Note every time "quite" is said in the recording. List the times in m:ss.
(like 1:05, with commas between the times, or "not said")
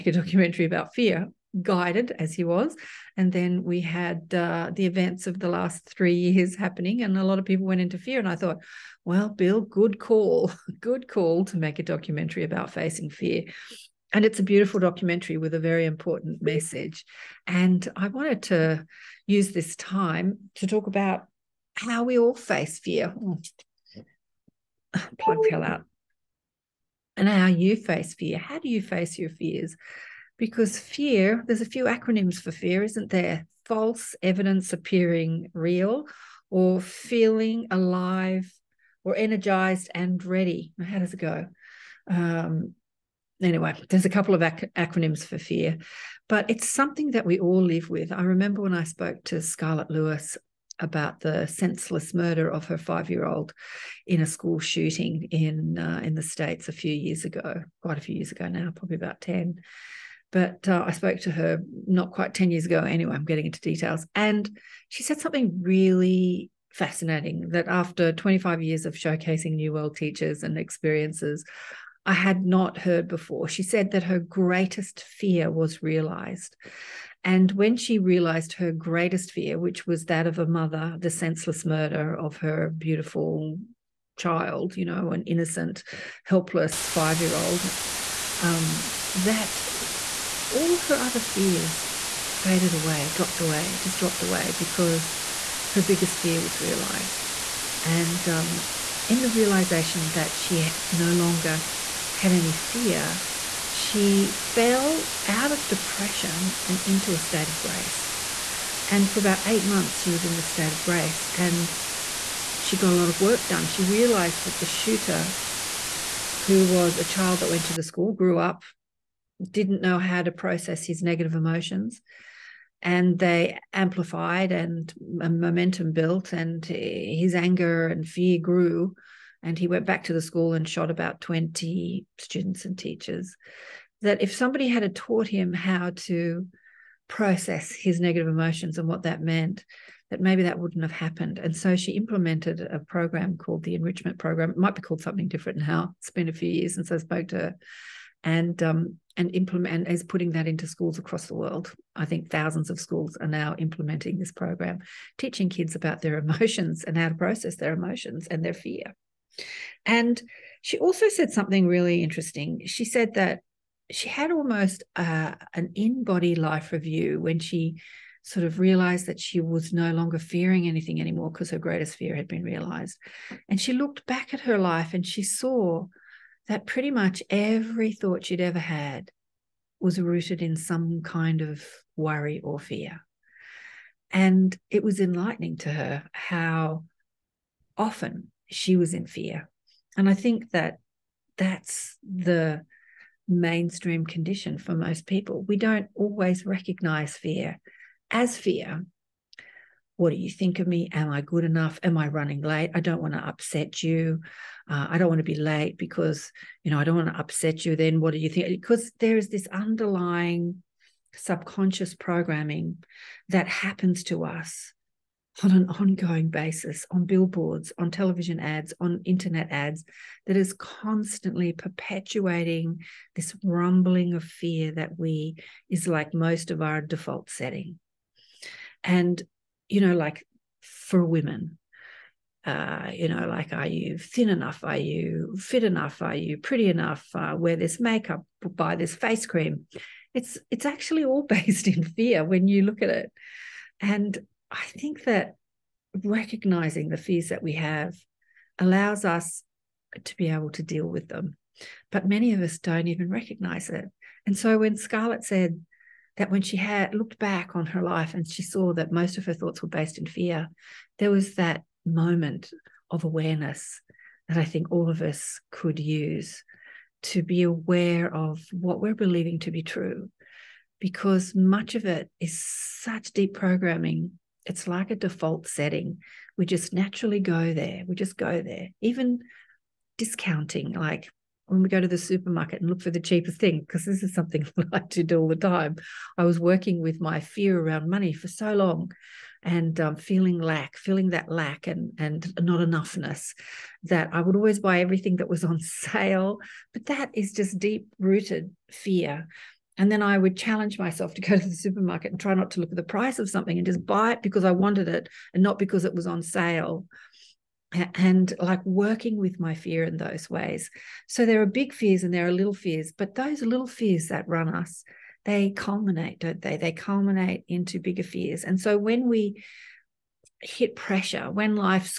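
0:57, 1:02.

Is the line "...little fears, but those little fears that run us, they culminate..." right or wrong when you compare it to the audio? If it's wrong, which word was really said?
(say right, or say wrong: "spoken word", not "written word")
right.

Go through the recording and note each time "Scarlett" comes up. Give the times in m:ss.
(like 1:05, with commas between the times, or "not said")
0:49, 4:14.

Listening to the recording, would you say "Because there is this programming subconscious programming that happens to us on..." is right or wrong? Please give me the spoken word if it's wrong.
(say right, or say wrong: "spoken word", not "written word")
wrong: "underlying", not "programming".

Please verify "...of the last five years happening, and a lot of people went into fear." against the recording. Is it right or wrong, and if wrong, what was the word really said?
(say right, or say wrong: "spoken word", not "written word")
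wrong: "three", not "five".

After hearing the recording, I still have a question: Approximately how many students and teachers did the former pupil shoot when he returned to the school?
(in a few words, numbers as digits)
20.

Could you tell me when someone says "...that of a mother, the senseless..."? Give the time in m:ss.
1:20.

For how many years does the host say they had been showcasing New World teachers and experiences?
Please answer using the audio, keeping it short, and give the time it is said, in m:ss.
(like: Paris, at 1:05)
25, at 1:08.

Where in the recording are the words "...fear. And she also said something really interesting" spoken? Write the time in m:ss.
2:38.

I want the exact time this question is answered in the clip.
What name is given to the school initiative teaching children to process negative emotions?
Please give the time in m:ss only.
2:23.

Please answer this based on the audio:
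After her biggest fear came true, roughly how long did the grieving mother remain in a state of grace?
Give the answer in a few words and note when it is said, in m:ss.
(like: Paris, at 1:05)
8 months, at 1:49.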